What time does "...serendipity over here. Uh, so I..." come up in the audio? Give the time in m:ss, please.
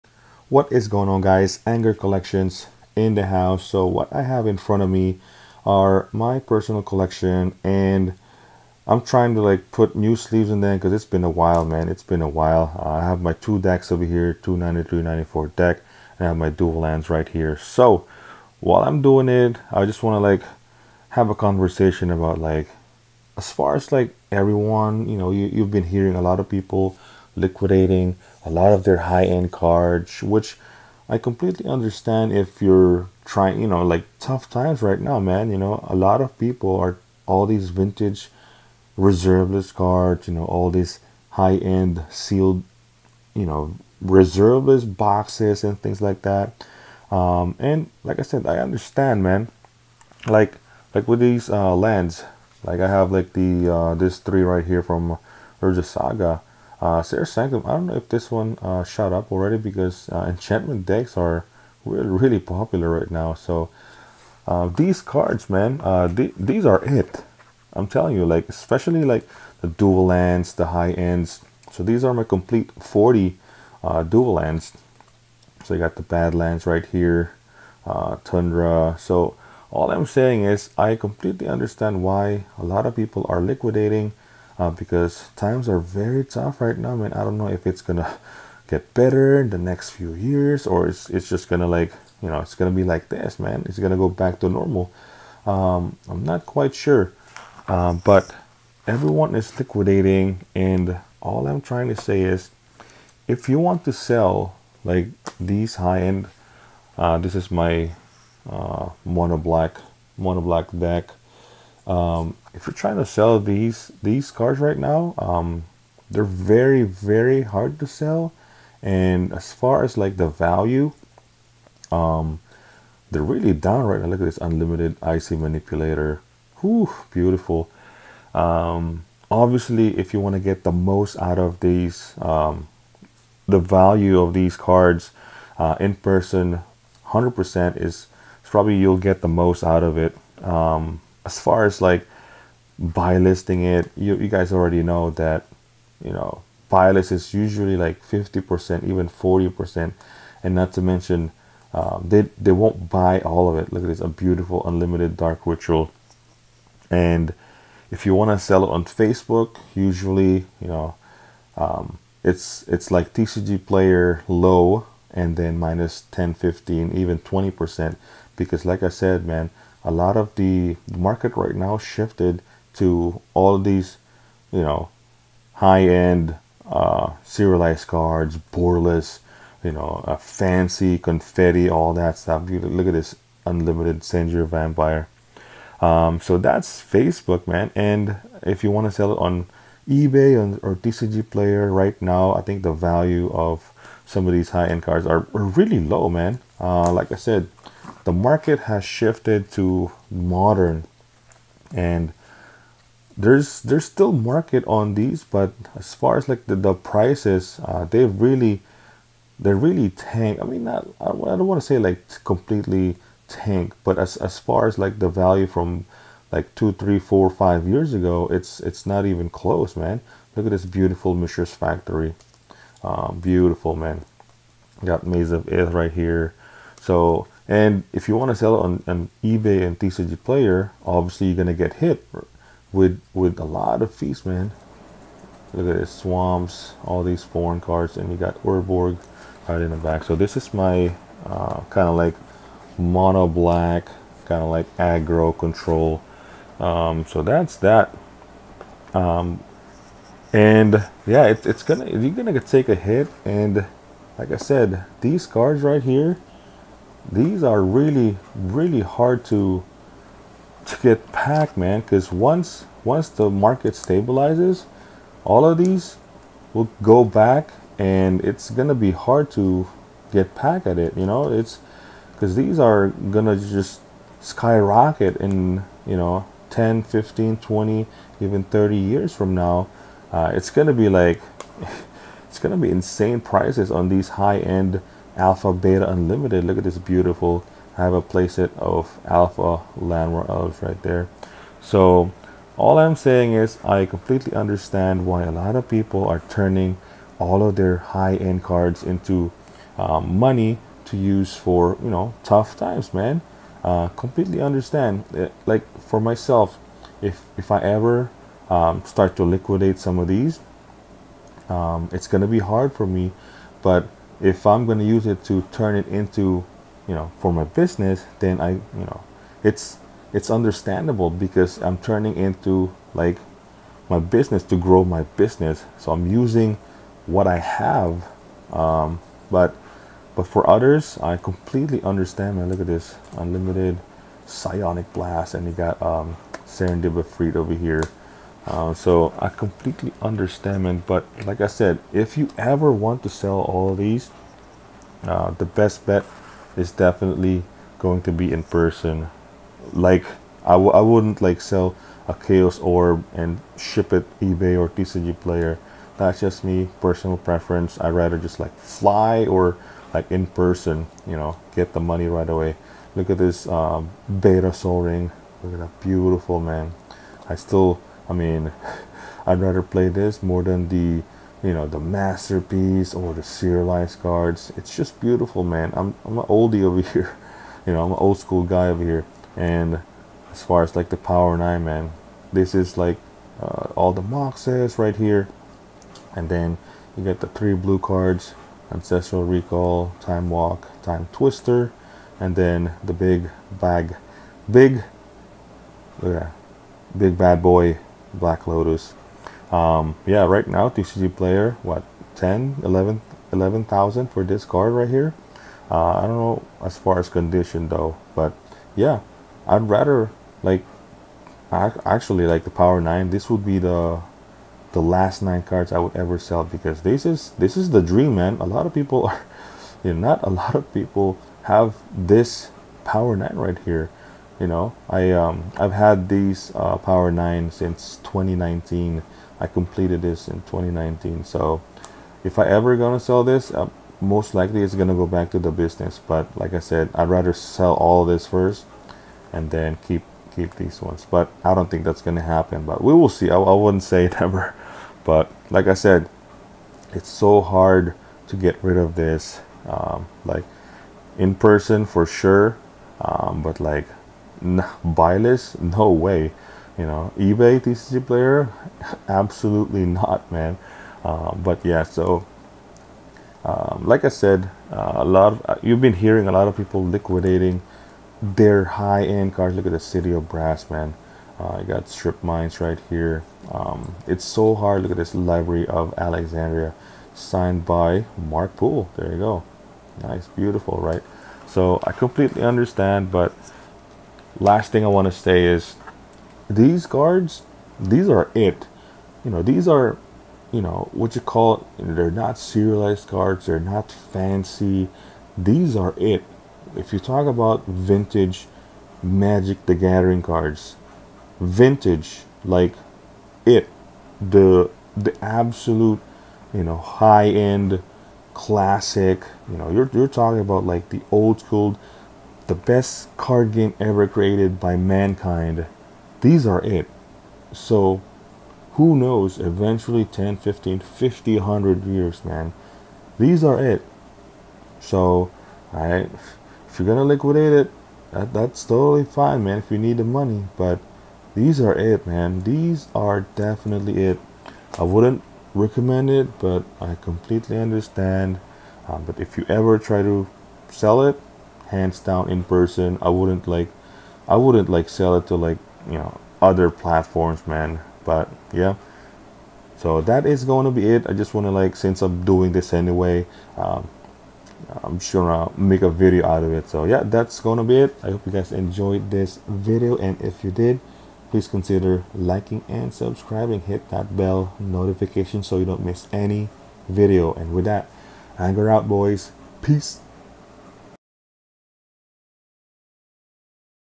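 5:36.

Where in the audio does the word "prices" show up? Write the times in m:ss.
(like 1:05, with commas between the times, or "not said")
3:26, 4:43.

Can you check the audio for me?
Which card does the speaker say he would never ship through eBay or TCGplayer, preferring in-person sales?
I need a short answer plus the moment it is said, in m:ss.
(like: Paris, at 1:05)
Chaos Orb, at 5:52.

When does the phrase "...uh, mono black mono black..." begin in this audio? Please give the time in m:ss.
1:48.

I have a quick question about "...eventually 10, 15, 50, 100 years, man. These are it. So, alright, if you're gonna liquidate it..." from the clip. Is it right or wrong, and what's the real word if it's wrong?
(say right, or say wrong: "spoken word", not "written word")
right.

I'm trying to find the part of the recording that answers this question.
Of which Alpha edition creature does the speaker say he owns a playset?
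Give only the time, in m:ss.
4:49.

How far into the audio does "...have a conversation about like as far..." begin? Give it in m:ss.
0:21.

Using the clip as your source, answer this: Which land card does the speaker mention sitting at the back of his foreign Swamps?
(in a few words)
Urborg.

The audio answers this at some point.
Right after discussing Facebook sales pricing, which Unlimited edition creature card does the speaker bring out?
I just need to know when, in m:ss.
3:04.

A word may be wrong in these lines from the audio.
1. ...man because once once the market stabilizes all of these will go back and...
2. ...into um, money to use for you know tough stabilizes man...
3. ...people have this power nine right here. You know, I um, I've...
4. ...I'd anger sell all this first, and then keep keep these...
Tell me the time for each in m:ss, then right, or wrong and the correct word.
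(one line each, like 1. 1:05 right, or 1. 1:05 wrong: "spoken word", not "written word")
1. 4:21 right
2. 4:58 wrong: "times", not "stabilizes"
3. 7:00 right
4. 7:16 wrong: "rather", not "anger".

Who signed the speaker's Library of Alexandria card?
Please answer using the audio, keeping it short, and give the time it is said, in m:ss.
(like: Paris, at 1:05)
Mark Poole, at 7:58.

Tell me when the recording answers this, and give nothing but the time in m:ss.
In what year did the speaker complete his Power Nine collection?
7:09.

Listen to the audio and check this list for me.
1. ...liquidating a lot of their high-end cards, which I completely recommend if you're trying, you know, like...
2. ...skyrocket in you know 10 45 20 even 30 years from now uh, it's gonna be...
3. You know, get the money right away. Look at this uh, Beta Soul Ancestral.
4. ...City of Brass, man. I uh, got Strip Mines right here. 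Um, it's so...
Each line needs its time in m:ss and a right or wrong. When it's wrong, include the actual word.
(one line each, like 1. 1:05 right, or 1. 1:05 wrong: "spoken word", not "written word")
1. 0:27 wrong: "understand", not "recommend"
2. 4:34 wrong: "15", not "45"
3. 6:01 wrong: "Ring", not "Ancestral"
4. 7:49 right.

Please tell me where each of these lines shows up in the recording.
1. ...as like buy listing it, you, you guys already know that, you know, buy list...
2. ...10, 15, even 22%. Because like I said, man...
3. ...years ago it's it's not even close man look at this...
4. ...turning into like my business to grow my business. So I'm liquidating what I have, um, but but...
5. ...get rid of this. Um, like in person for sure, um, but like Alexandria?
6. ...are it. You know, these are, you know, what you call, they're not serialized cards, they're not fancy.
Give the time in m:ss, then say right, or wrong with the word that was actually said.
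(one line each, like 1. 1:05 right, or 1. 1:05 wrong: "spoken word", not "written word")
1. 2:21 right
2. 2:46 wrong: "20", not "22"
3. 3:37 right
4. 5:21 wrong: "using", not "liquidating"
5. 7:28 wrong: "Buyless", not "Alexandria"
6. 8:08 right.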